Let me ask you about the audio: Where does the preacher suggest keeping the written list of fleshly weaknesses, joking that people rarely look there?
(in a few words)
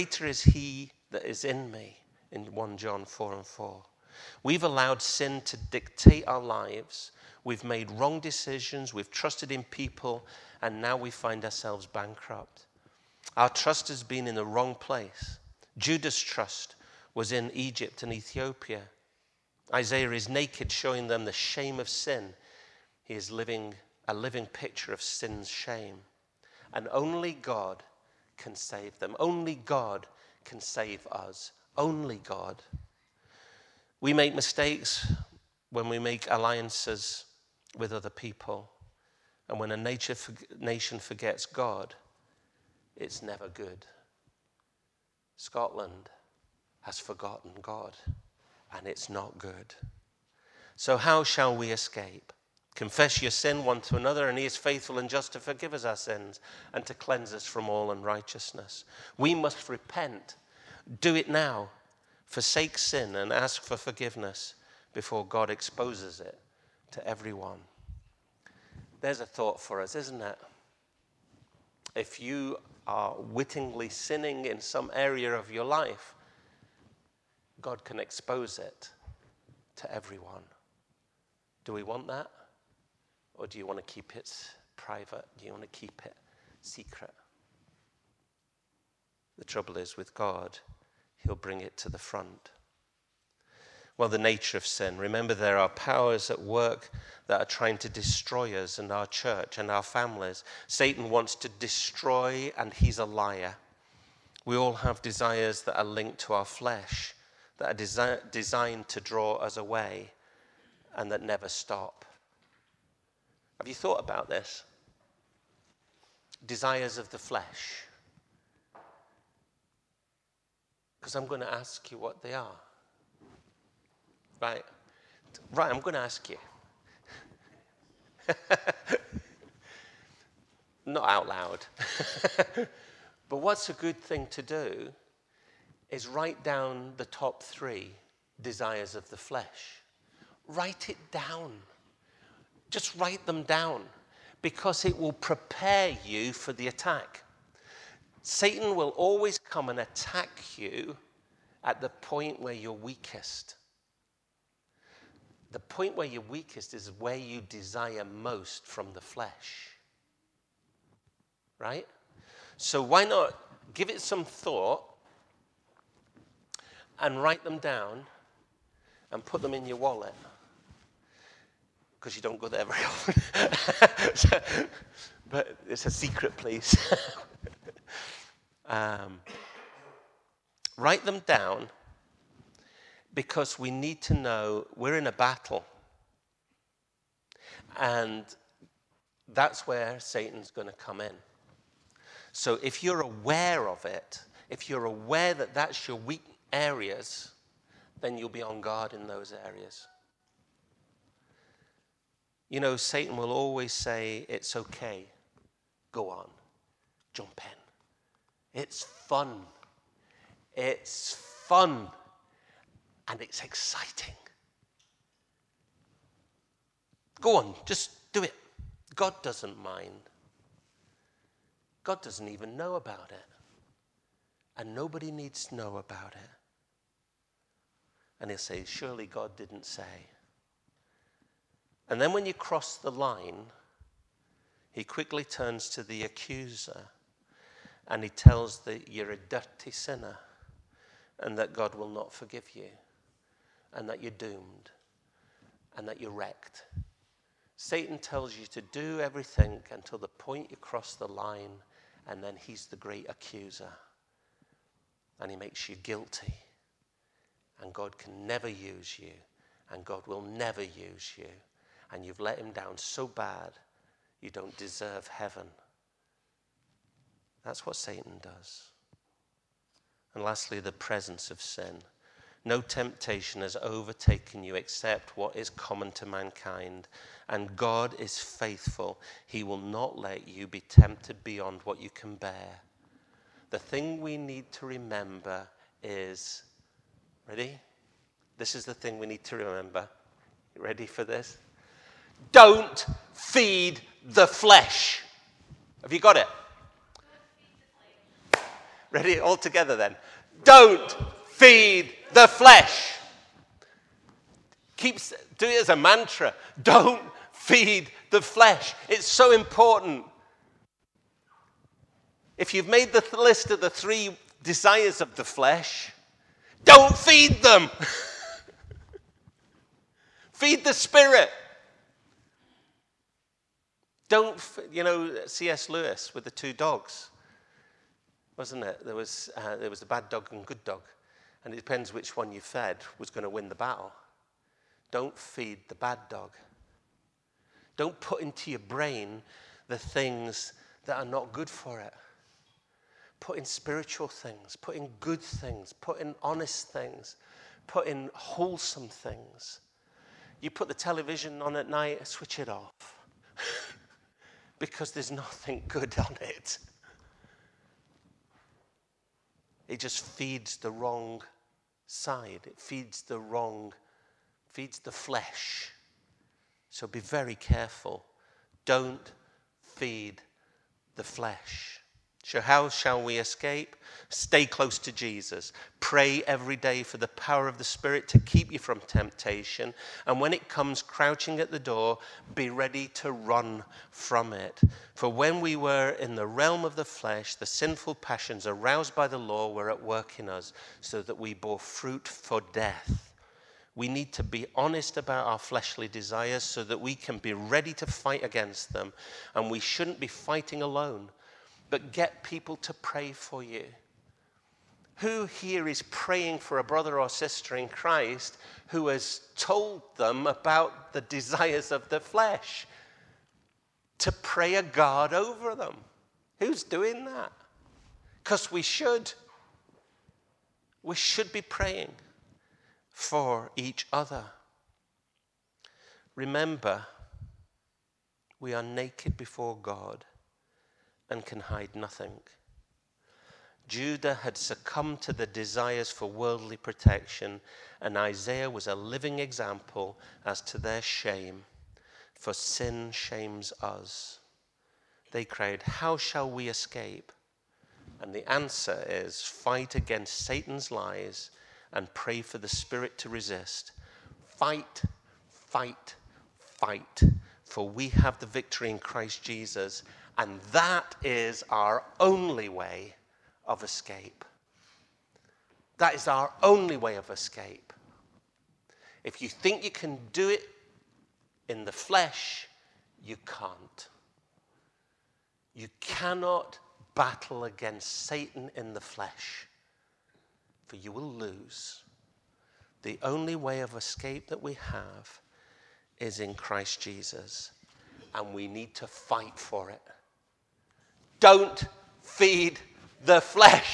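wallet.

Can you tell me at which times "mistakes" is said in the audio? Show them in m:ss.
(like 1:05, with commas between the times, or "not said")
0:34.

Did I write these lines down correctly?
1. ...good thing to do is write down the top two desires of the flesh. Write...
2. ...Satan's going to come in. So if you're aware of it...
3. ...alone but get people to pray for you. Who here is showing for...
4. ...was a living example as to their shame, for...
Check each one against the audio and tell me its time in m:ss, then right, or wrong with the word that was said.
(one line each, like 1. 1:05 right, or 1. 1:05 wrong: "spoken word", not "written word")
1. 2:13 wrong: "three", not "two"
2. 3:09 right
3. 6:40 wrong: "praying", not "showing"
4. 7:18 right.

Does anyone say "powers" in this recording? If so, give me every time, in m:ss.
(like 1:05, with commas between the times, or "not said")
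1:35, 6:17.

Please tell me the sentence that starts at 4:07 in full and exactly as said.
Satan tells you to do everything until the point you cross the line, and then he's the great accuser.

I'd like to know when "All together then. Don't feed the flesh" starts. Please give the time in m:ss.
4:59.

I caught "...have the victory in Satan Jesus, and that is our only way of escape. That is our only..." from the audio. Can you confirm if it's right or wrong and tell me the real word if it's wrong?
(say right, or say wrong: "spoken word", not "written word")
wrong: "Christ", not "Satan".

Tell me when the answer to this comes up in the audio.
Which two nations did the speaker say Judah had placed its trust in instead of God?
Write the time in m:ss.
0:17.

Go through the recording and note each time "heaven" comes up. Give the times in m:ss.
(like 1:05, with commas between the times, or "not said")
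4:25.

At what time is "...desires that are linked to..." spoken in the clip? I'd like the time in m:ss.
1:45.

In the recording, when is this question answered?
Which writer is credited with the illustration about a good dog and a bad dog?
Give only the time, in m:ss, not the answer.
5:25.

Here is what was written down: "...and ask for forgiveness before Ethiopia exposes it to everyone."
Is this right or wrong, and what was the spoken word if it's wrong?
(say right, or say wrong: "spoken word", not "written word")
wrong: "God", not "Ethiopia".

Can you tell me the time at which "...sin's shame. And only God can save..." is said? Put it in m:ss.
0:25.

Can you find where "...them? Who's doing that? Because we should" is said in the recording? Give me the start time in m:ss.
6:55.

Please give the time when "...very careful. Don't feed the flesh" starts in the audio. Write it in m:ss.
6:07.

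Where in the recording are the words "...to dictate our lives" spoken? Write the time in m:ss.
0:05.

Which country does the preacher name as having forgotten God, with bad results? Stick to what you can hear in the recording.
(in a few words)
Scotland.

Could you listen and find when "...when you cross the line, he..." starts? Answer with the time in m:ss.
3:52.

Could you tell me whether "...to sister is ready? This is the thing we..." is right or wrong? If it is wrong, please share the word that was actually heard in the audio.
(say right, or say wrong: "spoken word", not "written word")
wrong: "remember", not "sister".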